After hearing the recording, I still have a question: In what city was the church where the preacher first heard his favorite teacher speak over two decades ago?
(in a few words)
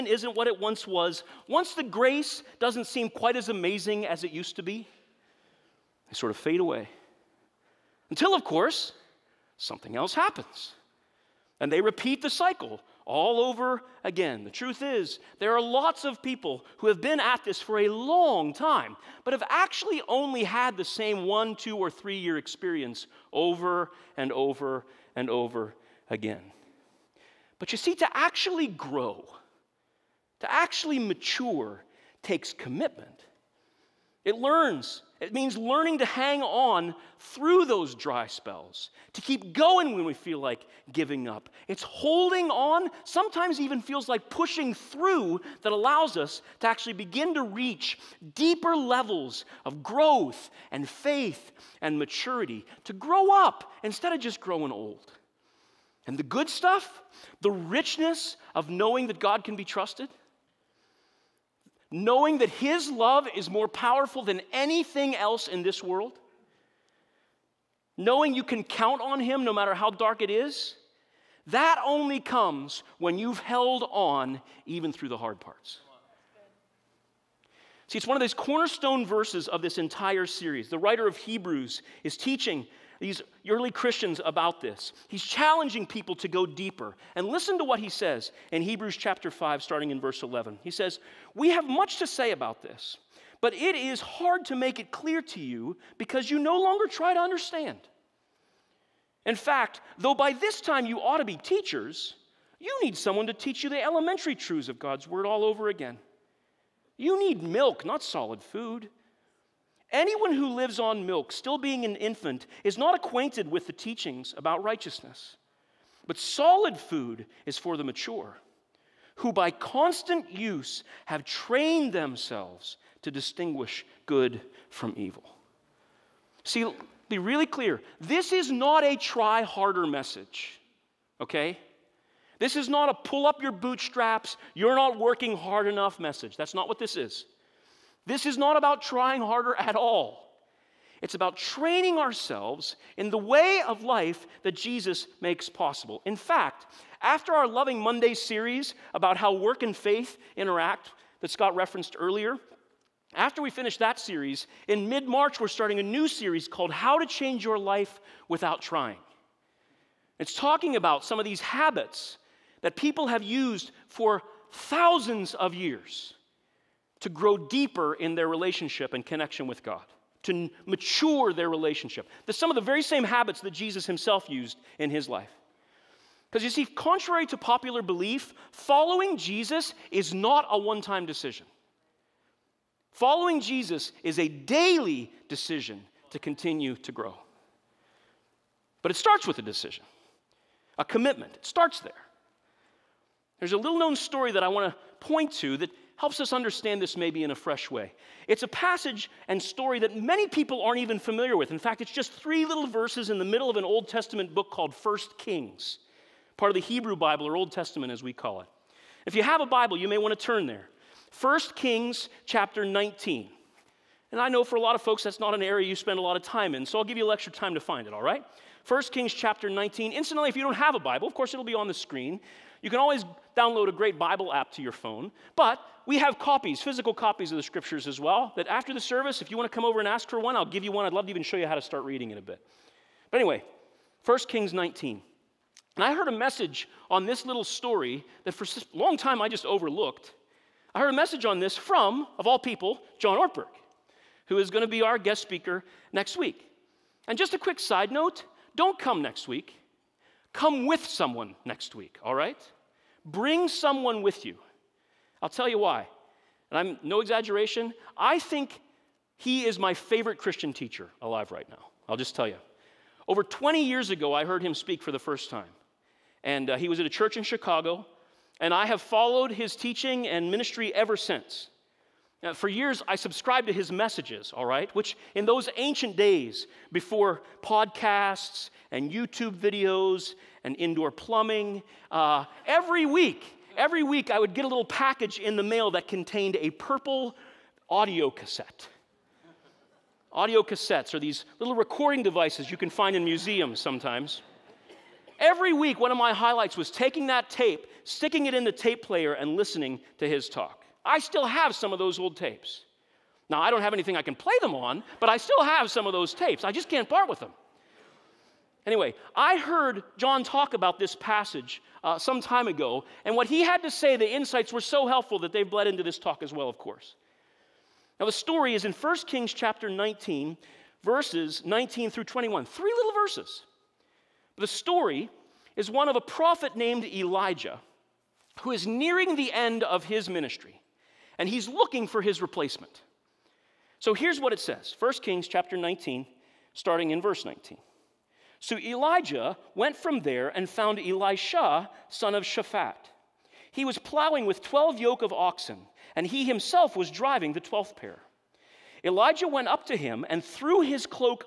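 Chicago.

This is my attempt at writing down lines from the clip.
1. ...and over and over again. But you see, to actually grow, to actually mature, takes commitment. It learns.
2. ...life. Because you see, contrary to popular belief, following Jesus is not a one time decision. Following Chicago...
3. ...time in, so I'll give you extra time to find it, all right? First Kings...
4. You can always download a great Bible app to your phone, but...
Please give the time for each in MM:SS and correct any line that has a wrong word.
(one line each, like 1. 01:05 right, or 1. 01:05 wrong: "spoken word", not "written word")
1. 00:24 right
2. 02:55 wrong: "Jesus", not "Chicago"
3. 03:36 right
4. 03:42 right.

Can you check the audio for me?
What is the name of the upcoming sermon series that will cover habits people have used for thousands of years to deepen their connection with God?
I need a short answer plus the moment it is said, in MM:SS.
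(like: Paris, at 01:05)
How to Change Your Life Without Trying, at 02:36.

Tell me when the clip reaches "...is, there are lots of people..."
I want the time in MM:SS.
00:14.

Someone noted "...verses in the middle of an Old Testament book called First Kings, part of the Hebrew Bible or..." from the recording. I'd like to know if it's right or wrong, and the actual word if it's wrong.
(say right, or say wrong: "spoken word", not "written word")
right.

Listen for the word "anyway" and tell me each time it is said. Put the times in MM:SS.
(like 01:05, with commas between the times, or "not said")
03:53, 05:08.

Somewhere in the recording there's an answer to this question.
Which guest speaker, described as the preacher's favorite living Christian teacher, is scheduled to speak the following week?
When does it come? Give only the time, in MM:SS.
04:02.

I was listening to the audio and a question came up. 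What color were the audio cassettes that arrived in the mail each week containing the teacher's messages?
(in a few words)
Purple.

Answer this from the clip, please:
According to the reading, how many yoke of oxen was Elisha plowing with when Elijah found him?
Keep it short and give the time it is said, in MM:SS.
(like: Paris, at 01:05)
12, at 05:44.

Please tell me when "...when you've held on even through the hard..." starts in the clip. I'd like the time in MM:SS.
01:12.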